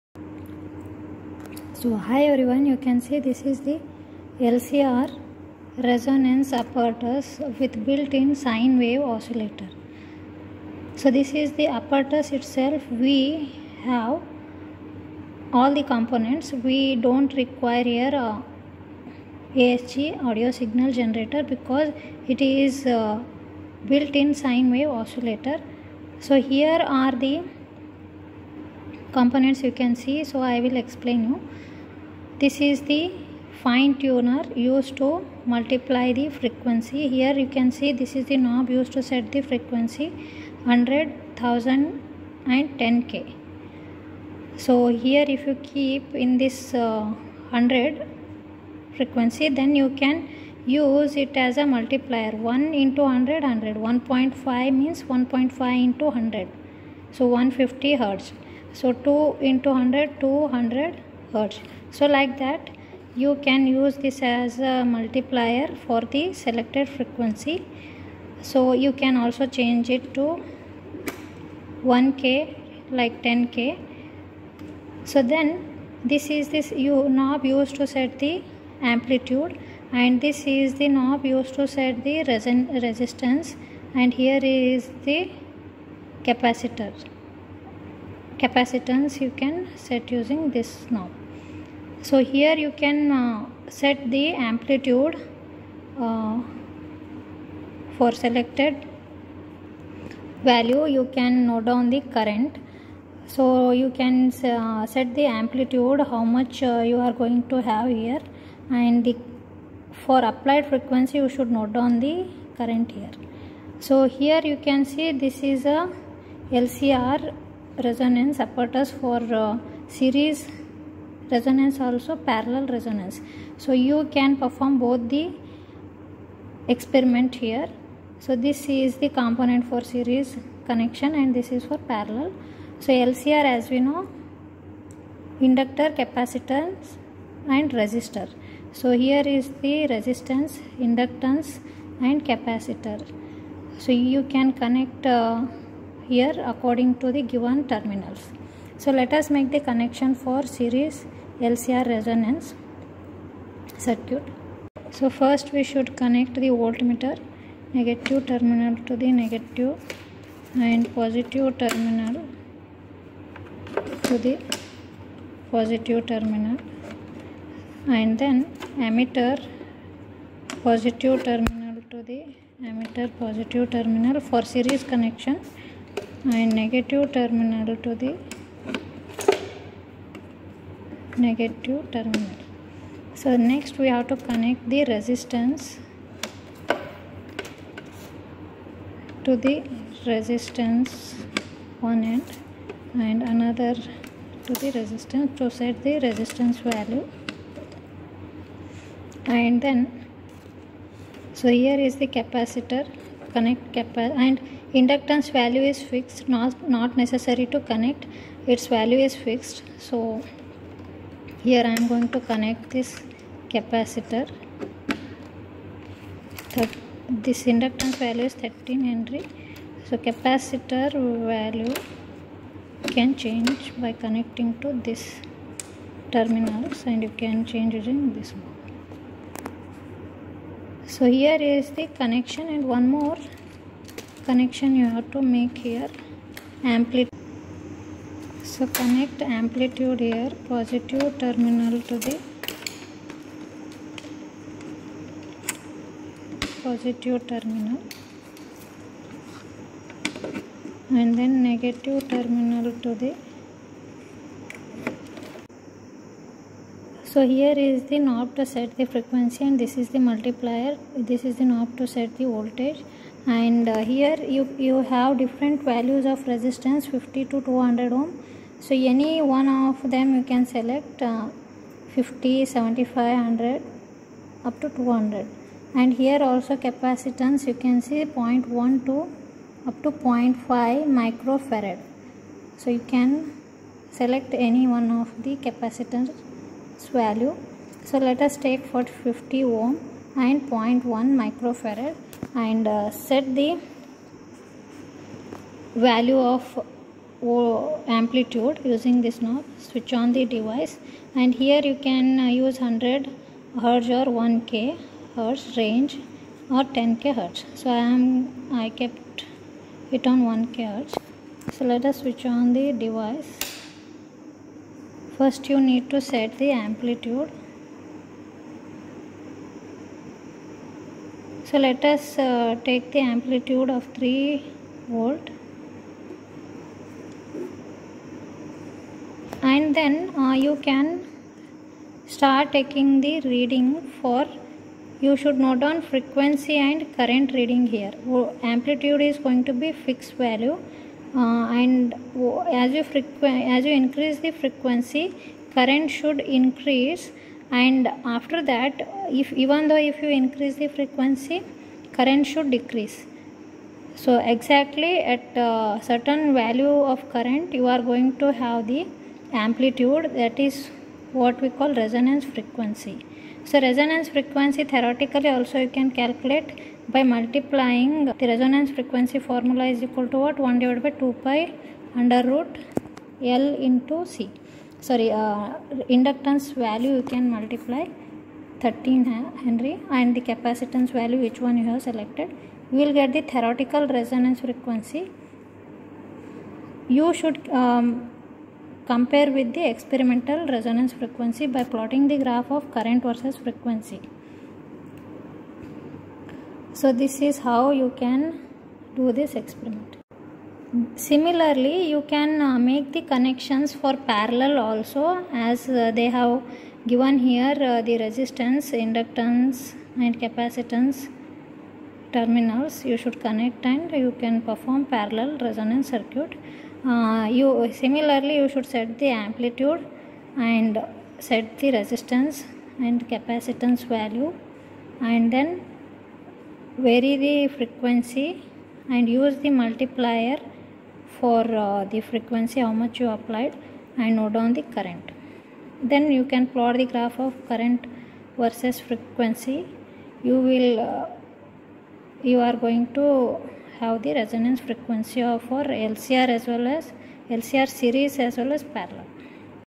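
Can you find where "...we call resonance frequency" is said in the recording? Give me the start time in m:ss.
6:01.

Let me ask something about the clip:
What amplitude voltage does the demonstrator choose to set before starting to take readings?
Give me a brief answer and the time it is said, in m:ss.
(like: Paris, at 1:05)
3 volt, at 5:23.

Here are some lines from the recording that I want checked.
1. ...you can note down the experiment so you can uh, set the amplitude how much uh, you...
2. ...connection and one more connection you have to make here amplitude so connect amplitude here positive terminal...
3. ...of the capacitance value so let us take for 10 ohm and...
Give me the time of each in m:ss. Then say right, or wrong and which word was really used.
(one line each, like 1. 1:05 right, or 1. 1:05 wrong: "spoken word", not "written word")
1. 1:40 wrong: "current", not "experiment"
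2. 3:52 right
3. 4:45 wrong: "50", not "10".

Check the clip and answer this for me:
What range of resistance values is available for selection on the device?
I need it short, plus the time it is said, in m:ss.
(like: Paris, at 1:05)
50 to 200 ohm, at 4:26.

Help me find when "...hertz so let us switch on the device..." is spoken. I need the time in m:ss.
5:10.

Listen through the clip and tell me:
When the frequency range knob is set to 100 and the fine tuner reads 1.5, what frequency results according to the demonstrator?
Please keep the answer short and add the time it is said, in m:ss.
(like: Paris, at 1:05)
150 hertz, at 0:57.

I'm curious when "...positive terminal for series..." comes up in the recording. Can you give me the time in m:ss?
2:53.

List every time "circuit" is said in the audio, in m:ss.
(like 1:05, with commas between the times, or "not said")
2:33, 6:55.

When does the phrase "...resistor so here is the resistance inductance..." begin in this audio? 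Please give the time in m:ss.
2:17.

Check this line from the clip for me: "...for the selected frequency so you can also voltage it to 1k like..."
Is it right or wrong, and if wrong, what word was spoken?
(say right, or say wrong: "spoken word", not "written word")
wrong: "change", not "voltage".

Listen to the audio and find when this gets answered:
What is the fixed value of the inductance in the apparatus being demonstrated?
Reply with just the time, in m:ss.
3:38.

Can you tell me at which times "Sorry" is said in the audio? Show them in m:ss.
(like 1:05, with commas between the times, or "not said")
6:14.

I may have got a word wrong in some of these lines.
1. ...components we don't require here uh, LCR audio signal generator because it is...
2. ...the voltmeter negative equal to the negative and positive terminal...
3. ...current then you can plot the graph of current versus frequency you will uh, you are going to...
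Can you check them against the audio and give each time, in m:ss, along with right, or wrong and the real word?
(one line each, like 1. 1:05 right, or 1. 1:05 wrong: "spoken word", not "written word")
1. 0:15 wrong: "ASG", not "LCR"
2. 2:36 wrong: "terminal", not "equal"
3. 7:14 right.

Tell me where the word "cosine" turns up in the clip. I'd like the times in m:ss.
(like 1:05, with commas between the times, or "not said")
not said.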